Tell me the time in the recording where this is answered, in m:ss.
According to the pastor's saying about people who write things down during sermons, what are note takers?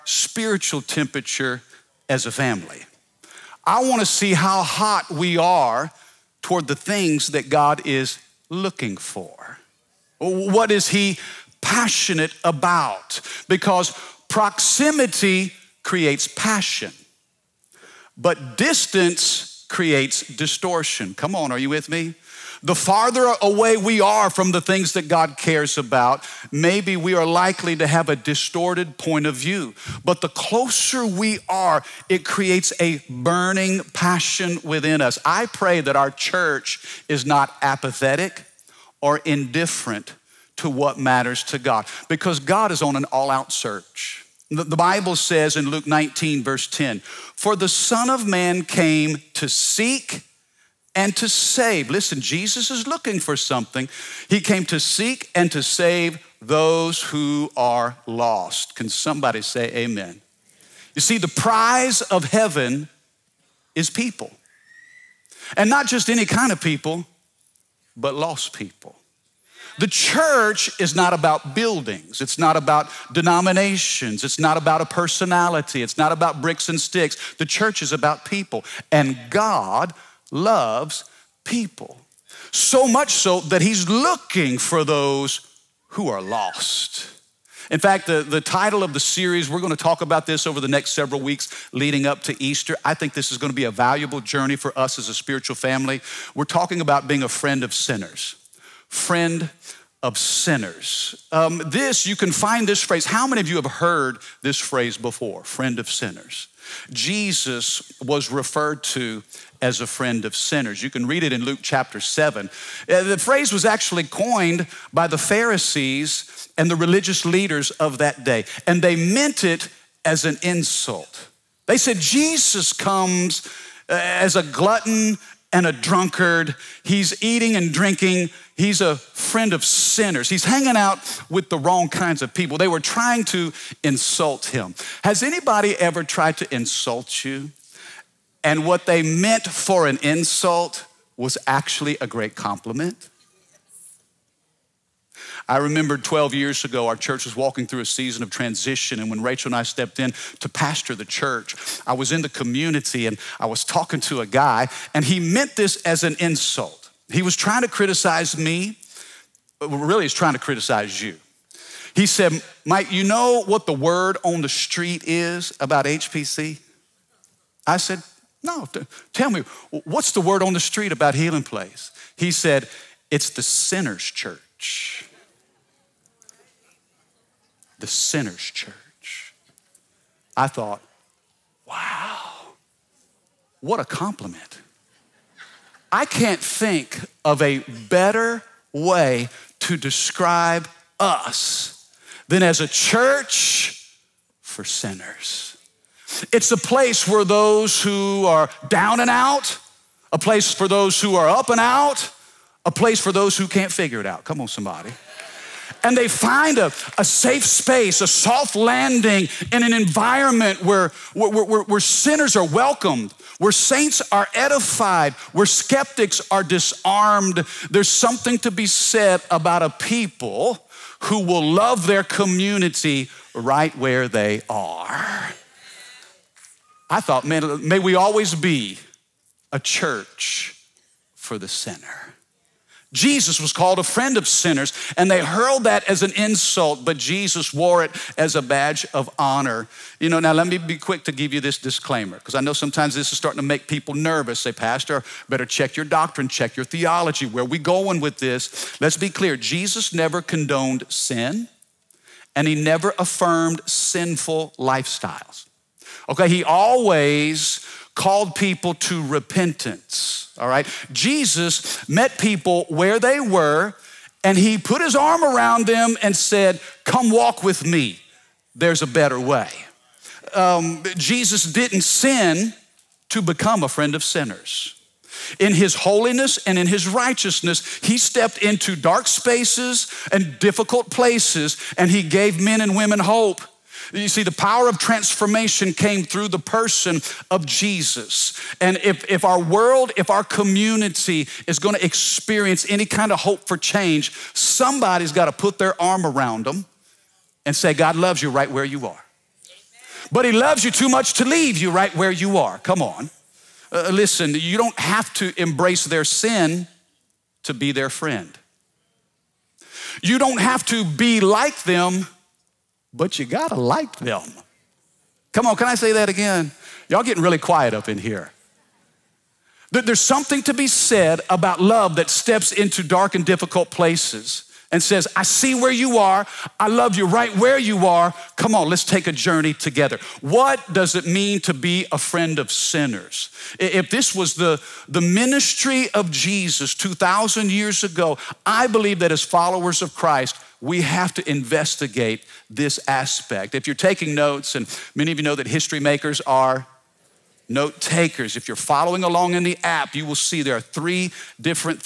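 5:45.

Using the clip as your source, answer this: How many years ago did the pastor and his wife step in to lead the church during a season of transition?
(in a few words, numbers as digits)
12.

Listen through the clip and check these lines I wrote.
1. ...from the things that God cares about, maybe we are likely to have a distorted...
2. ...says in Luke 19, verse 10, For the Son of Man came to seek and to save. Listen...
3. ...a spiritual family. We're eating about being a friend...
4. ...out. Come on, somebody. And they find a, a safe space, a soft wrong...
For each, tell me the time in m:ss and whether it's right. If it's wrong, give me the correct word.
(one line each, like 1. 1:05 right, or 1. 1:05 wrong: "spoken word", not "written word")
1. 0:24 right
2. 0:45 right
3. 1:35 wrong: "talking", not "eating"
4. 3:24 wrong: "landing", not "wrong".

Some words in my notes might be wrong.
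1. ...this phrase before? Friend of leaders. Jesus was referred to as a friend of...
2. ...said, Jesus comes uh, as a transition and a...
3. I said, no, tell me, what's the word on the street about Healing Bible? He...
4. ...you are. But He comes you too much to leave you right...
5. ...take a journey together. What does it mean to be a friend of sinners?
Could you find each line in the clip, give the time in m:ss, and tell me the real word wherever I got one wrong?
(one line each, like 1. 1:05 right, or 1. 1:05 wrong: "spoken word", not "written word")
1. 1:44 wrong: "sinners", not "leaders"
2. 2:01 wrong: "glutton", not "transition"
3. 2:47 wrong: "Place", not "Bible"
4. 4:58 wrong: "loves", not "comes"
5. 5:28 right.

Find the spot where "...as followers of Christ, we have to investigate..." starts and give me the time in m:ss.
5:39.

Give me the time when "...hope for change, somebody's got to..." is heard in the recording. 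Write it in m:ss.
4:53.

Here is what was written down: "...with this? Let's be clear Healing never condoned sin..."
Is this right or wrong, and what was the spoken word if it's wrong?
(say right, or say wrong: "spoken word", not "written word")
wrong: "Jesus", not "Healing".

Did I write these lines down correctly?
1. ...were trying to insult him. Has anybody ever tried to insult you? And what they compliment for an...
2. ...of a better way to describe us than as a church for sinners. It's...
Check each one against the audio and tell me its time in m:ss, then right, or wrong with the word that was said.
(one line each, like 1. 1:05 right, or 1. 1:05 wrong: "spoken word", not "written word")
1. 2:12 wrong: "meant", not "compliment"
2. 3:07 right.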